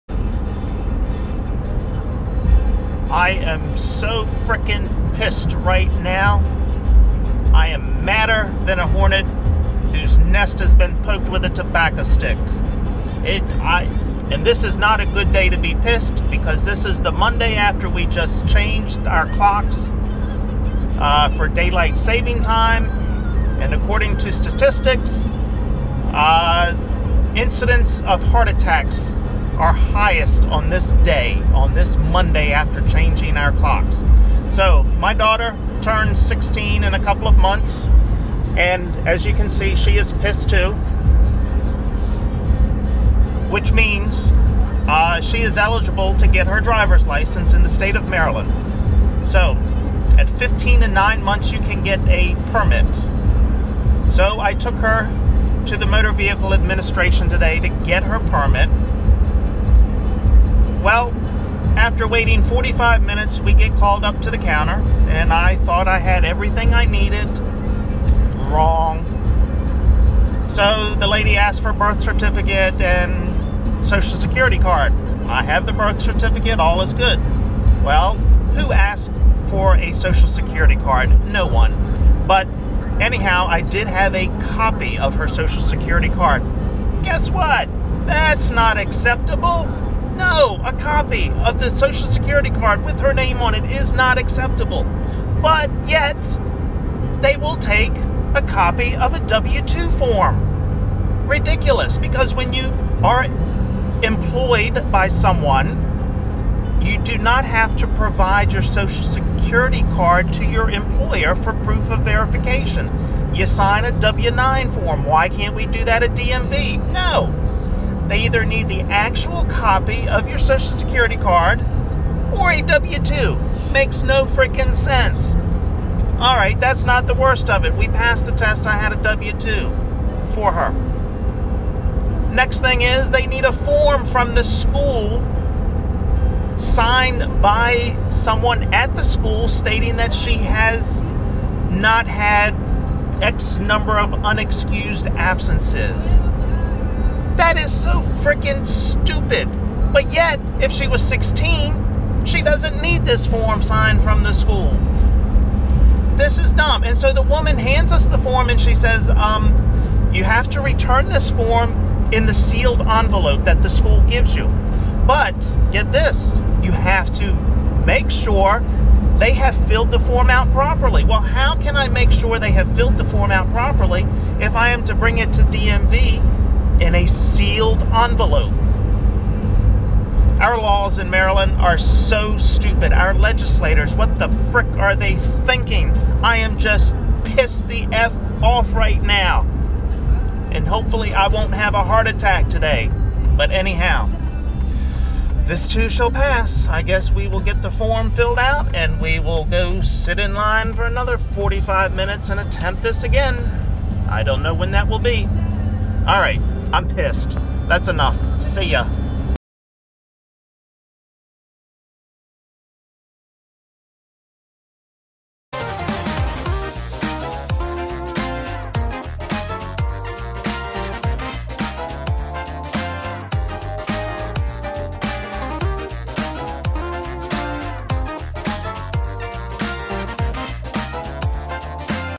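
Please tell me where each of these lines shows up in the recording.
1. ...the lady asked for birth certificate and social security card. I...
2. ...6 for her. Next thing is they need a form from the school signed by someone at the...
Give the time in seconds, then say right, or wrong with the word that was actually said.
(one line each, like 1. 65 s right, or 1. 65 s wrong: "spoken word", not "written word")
1. 70 s right
2. 129 s wrong: "2", not "6".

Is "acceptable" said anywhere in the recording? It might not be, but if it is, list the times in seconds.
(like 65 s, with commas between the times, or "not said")
88 s, 94 s.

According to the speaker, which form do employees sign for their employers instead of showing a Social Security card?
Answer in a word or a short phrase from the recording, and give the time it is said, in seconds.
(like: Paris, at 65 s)
W-9, at 114 s.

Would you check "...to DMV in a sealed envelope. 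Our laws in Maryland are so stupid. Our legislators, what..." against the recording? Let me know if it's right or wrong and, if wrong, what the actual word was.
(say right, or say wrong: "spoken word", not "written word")
right.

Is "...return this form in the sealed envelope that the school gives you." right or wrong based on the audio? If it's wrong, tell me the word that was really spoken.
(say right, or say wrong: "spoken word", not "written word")
right.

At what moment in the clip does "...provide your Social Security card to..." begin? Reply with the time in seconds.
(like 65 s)
107 s.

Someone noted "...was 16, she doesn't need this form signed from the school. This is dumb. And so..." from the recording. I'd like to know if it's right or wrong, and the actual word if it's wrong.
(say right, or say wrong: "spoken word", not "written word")
right.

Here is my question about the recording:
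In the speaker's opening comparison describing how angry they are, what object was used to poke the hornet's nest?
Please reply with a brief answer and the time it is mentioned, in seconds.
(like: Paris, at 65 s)
tobacco stick, at 11 s.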